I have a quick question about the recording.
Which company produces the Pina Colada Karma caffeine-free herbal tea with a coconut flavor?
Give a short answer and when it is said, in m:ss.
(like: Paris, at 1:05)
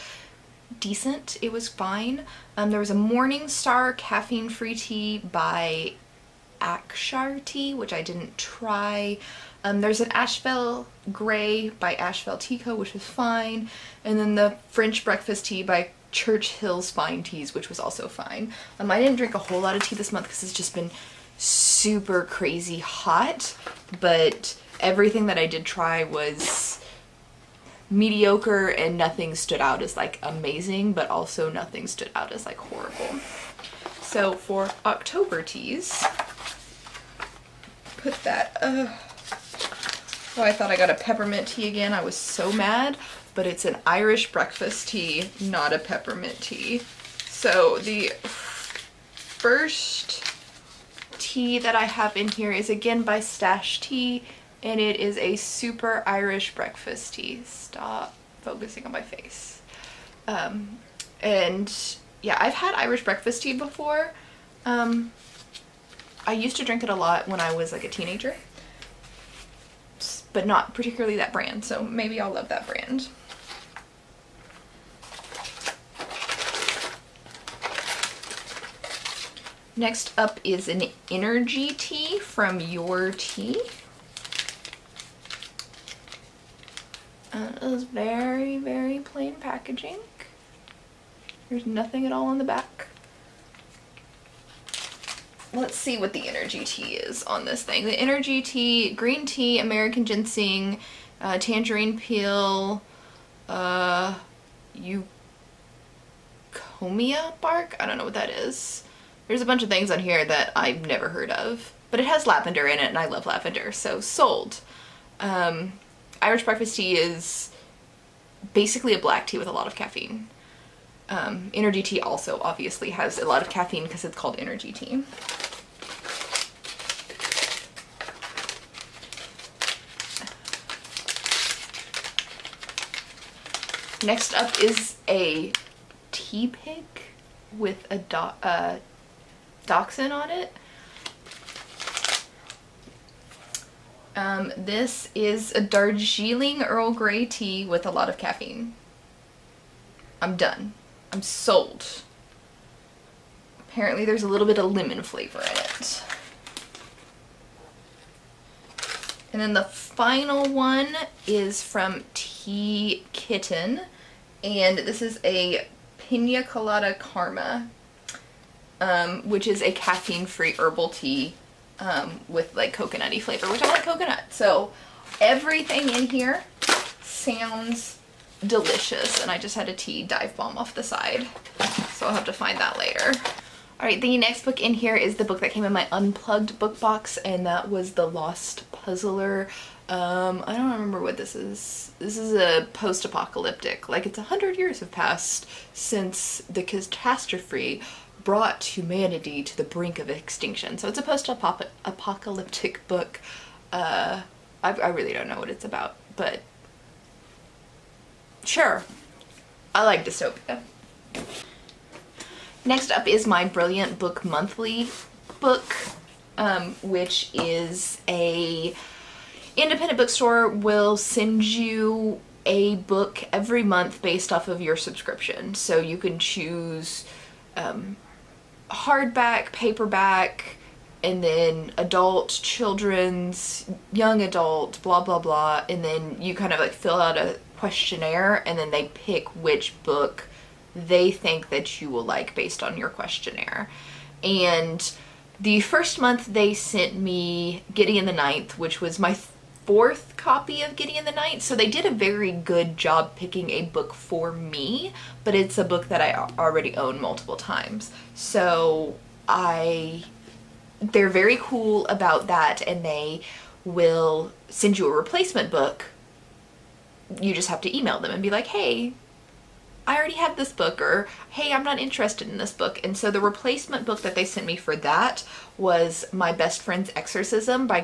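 Tea Kitten, at 2:42.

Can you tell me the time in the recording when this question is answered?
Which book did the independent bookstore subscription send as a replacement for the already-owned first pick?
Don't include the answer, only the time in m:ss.
4:36.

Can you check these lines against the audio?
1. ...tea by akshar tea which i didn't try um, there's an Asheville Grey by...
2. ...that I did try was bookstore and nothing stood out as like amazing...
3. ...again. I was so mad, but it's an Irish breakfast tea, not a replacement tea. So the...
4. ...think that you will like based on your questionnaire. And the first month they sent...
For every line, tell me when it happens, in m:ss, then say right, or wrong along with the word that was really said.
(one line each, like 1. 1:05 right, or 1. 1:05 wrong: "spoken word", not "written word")
1. 0:04 right
2. 0:25 wrong: "mediocre", not "bookstore"
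3. 0:41 wrong: "peppermint", not "replacement"
4. 4:01 right.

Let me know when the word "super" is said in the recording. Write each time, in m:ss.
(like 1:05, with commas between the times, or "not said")
0:21, 0:55.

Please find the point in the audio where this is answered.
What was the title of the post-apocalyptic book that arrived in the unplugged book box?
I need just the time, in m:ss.
3:07.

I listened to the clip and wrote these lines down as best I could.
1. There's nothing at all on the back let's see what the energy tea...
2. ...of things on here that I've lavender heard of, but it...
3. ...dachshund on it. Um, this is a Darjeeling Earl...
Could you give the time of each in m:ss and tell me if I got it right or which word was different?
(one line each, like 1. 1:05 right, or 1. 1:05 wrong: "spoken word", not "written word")
1. 1:31 right
2. 1:49 wrong: "never", not "lavender"
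3. 2:19 right.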